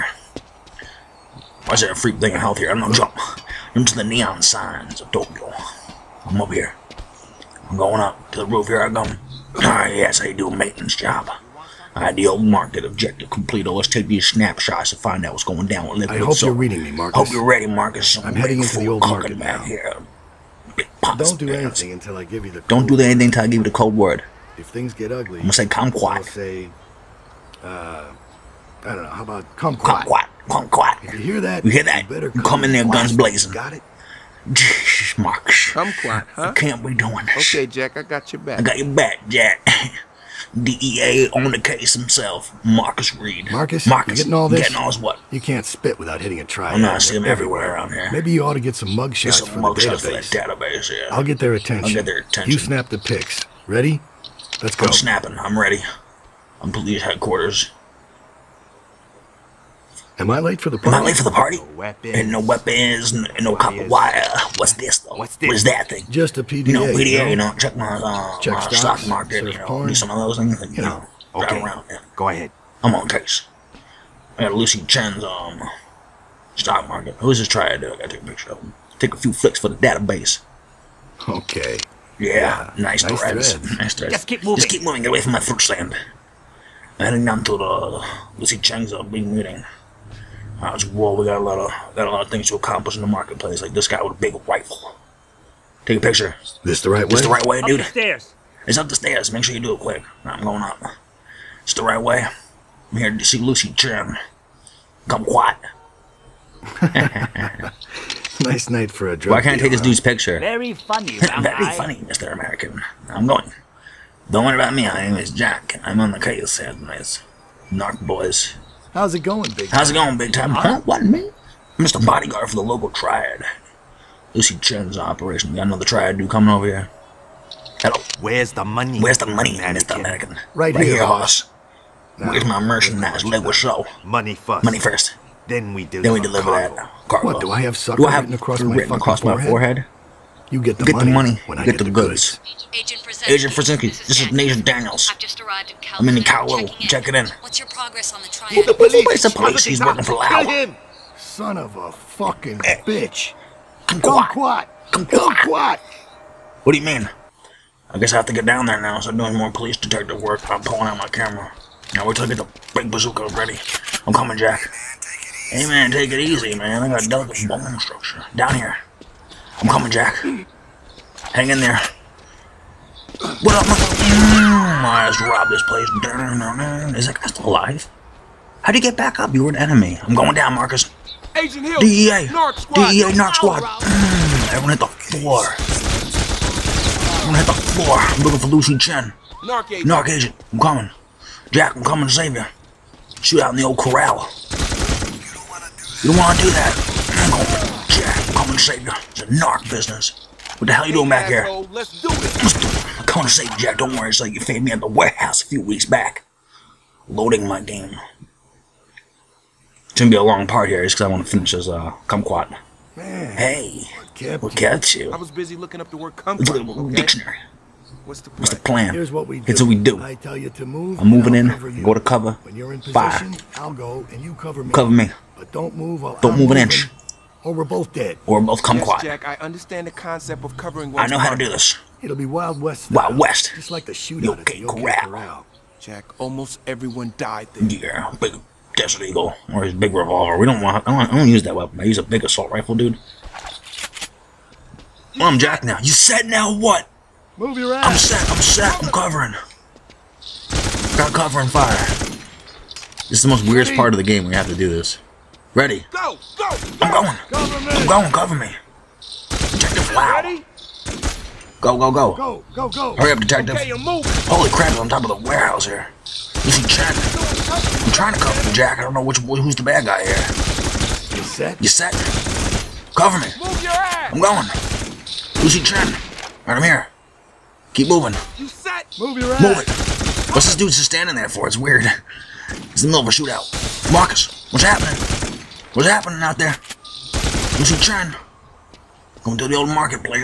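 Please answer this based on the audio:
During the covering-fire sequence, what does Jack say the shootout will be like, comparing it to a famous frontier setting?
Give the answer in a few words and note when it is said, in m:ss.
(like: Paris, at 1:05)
Wild West, at 3:52.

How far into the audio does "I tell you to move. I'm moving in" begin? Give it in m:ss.
3:40.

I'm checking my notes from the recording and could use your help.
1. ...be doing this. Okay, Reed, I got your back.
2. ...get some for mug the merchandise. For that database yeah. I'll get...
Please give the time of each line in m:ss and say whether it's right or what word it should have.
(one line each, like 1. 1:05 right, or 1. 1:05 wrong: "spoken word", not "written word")
1. 0:36 wrong: "Jack", not "Reed"
2. 0:49 wrong: "database", not "merchandise".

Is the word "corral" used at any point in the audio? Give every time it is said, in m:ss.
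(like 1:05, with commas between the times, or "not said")
3:13.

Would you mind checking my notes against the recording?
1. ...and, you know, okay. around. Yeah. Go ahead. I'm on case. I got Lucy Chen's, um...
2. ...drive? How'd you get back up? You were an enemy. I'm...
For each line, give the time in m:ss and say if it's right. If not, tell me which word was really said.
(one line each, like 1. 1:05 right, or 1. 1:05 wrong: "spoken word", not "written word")
1. 1:10 right
2. 2:57 wrong: "alive", not "drive".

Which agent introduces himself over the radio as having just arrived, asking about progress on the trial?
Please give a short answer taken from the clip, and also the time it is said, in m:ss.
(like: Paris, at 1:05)
Nathan Daniels, at 2:24.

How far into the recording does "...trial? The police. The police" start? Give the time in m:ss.
2:28.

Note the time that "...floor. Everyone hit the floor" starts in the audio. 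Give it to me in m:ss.
3:04.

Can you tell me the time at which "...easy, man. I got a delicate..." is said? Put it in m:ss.
2:46.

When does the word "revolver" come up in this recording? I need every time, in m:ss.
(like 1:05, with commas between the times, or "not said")
3:59.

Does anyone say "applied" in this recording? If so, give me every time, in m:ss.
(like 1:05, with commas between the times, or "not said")
not said.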